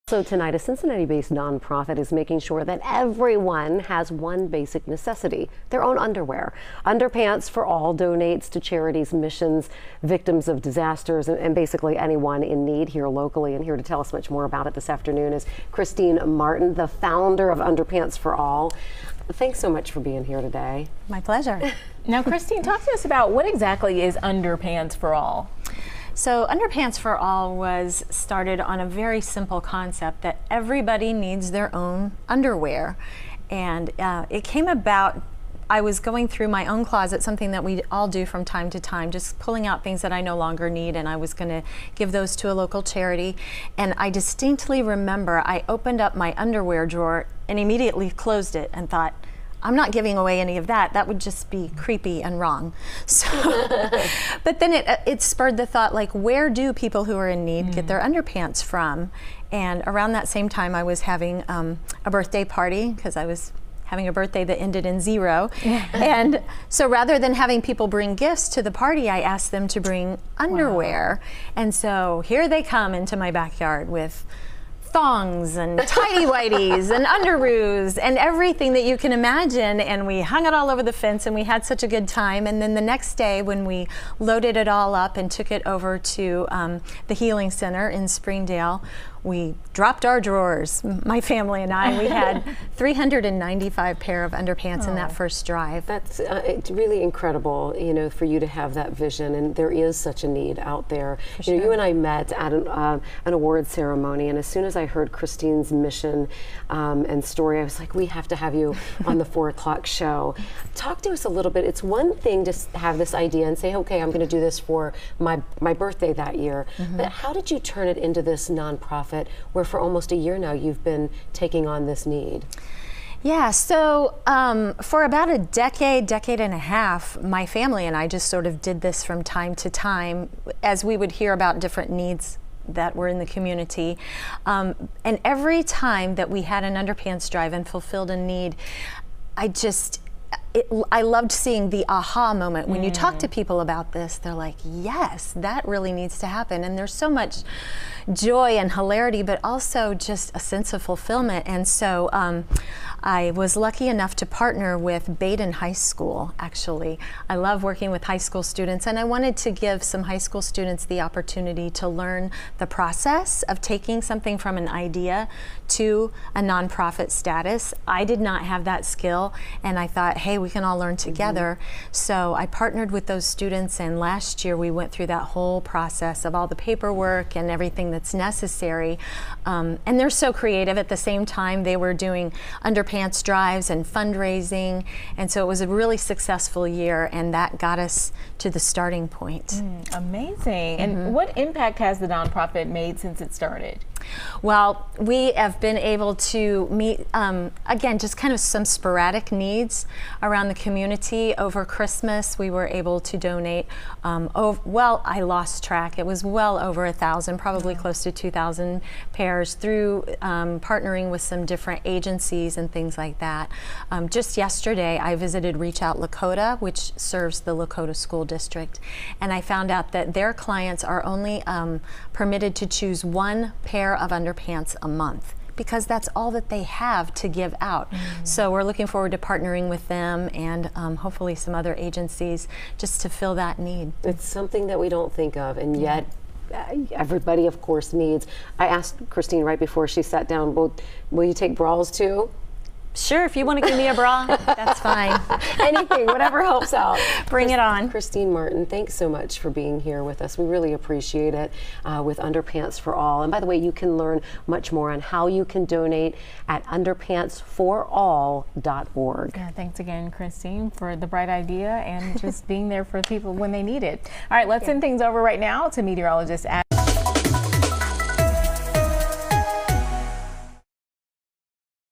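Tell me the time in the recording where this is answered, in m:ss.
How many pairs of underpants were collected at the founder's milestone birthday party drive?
1:32.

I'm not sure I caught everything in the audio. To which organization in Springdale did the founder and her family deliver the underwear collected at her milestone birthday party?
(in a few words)
The Healing Center.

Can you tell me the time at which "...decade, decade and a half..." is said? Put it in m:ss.
2:05.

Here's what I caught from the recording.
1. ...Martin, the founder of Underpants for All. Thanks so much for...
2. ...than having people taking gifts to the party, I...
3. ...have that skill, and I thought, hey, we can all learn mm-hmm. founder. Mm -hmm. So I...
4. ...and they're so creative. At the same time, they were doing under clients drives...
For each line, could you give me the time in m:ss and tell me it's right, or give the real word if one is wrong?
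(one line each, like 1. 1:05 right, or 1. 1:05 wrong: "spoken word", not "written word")
1. 0:16 right
2. 1:07 wrong: "bring", not "taking"
3. 2:48 wrong: "together", not "founder"
4. 2:59 wrong: "pants", not "clients".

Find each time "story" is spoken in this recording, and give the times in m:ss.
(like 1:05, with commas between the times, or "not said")
1:47.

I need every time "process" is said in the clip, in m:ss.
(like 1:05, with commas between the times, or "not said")
2:42, 2:55.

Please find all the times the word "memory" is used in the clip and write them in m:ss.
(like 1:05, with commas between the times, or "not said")
not said.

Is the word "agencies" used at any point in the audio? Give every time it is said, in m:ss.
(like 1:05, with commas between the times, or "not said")
3:31, 3:51.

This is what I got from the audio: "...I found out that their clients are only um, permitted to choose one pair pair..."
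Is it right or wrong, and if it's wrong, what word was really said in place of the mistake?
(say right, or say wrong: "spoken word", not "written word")
right.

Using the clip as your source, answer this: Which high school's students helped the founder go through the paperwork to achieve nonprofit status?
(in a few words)
Badin High School.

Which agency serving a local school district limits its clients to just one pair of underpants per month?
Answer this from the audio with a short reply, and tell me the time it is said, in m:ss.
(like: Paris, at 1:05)
Reach Out Lakota, at 3:35.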